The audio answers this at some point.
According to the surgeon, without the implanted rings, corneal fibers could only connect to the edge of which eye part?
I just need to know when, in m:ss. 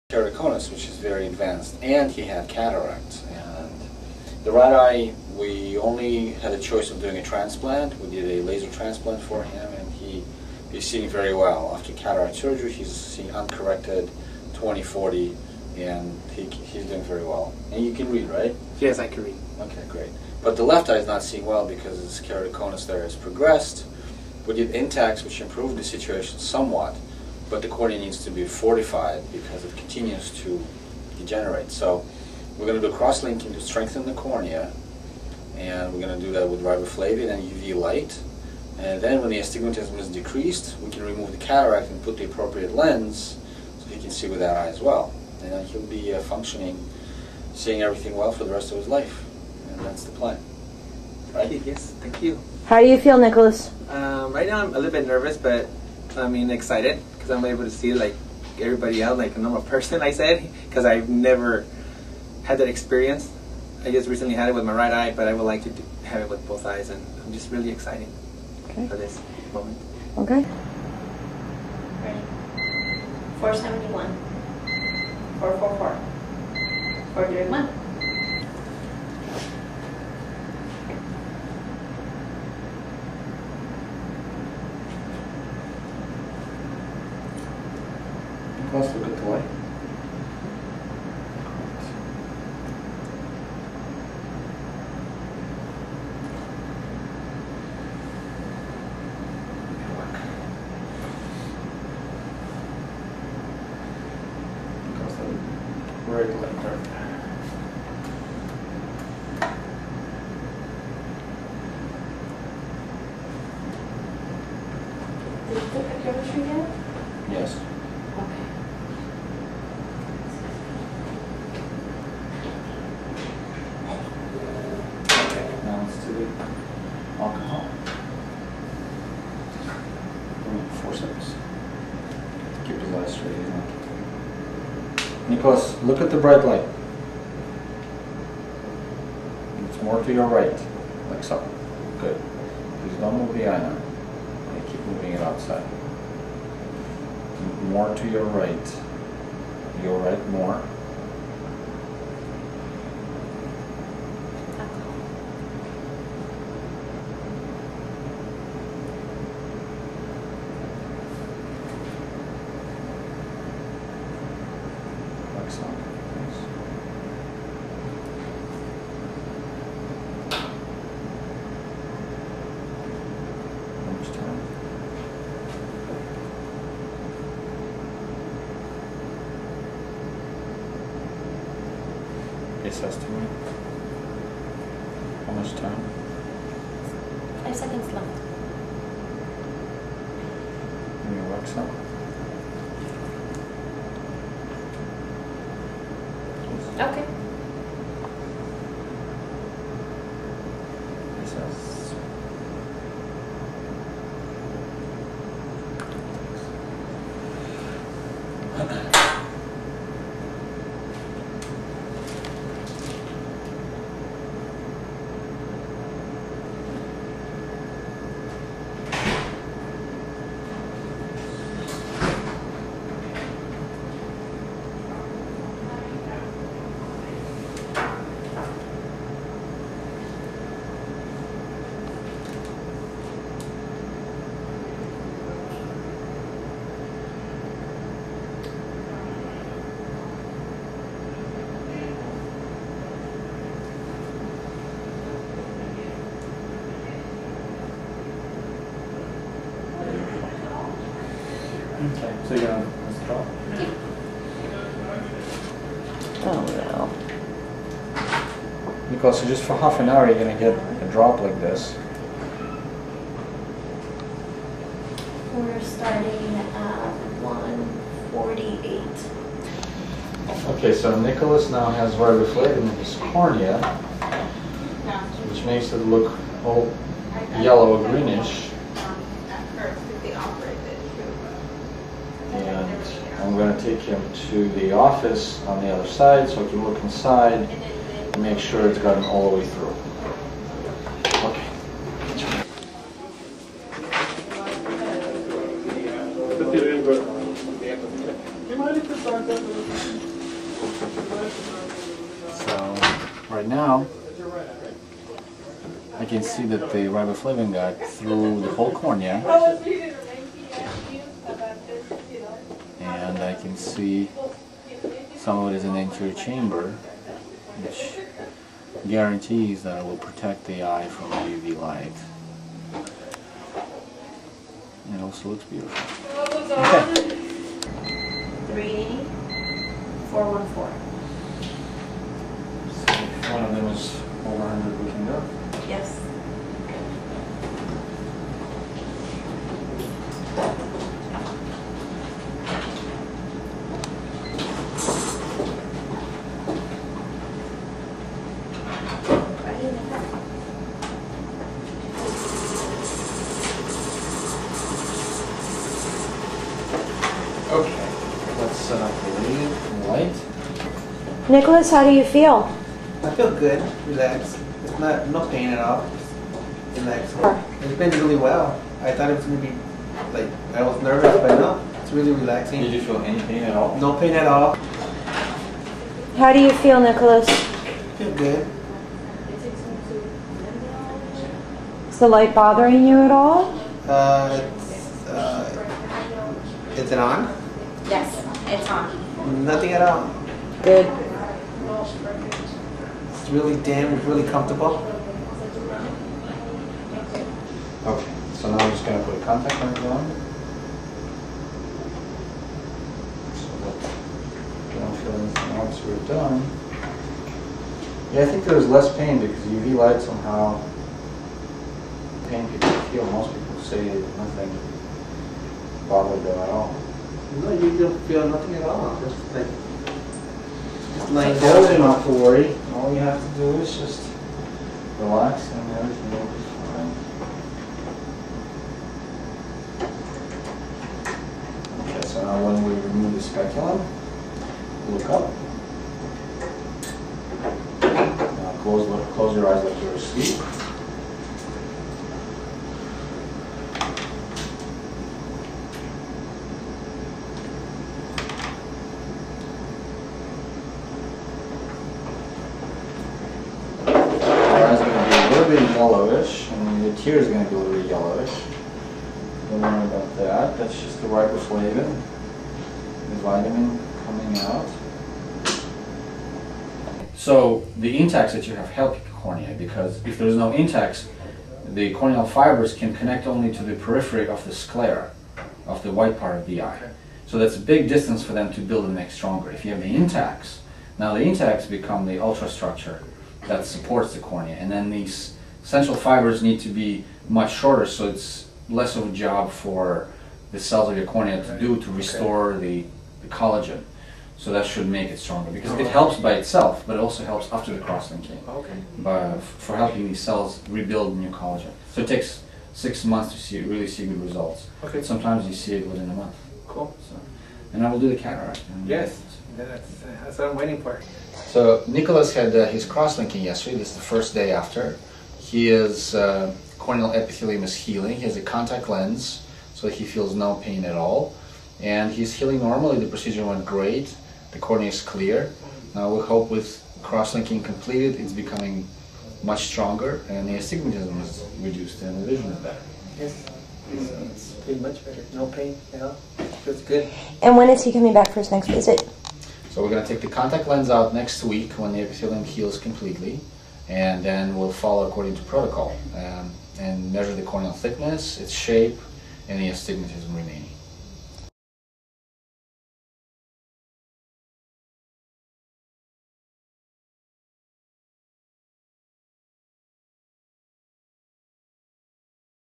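7:54.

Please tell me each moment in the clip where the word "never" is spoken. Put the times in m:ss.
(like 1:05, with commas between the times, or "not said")
1:01.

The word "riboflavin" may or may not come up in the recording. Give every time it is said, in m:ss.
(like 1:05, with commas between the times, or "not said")
0:36, 4:31, 5:06, 7:41.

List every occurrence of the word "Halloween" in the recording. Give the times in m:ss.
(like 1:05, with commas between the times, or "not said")
not said.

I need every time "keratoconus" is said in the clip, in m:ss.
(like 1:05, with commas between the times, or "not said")
0:00, 0:22.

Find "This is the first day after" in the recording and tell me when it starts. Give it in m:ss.
8:33.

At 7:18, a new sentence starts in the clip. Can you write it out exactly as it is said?
Now close, close your eyes like you're asleep.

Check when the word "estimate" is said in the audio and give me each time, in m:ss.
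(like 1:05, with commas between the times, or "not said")
3:02.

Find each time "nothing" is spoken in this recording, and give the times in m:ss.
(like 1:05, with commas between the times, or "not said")
6:29, 6:54, 6:58.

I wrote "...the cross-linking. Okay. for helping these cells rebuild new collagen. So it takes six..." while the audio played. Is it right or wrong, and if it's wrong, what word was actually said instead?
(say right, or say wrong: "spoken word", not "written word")
right.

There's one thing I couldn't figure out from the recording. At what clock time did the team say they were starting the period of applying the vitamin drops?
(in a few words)
1:48.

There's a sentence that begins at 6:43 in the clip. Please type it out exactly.
So that you don't feel anything once we're done.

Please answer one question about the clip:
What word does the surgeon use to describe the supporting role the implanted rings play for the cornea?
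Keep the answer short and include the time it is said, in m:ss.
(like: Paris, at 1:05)
ultrastructure, at 8:02.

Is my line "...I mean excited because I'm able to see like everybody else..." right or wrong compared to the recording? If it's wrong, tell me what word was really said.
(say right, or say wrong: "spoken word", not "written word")
right.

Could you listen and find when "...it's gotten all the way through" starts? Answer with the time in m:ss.
4:48.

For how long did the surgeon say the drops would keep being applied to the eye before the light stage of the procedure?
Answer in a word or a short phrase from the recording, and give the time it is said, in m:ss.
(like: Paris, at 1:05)
half an hour, at 4:19.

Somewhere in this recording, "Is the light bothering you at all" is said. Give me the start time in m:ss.
6:21.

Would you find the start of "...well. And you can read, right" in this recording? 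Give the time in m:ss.
0:17.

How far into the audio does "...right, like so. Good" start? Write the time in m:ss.
2:20.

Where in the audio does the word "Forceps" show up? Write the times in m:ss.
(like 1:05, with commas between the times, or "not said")
2:10.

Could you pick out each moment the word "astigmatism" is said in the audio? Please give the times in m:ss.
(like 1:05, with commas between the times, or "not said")
0:39, 8:50, 9:09.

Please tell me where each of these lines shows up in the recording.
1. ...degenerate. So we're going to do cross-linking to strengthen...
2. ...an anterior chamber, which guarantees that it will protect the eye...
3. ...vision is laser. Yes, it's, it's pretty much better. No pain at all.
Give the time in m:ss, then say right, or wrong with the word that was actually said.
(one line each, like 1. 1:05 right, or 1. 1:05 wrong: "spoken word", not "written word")
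1. 0:31 right
2. 5:15 right
3. 8:52 wrong: "better", not "laser".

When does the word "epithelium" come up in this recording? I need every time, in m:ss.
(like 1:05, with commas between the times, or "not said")
8:37, 9:02.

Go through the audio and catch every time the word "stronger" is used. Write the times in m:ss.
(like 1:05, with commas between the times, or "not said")
7:59, 8:15, 8:49.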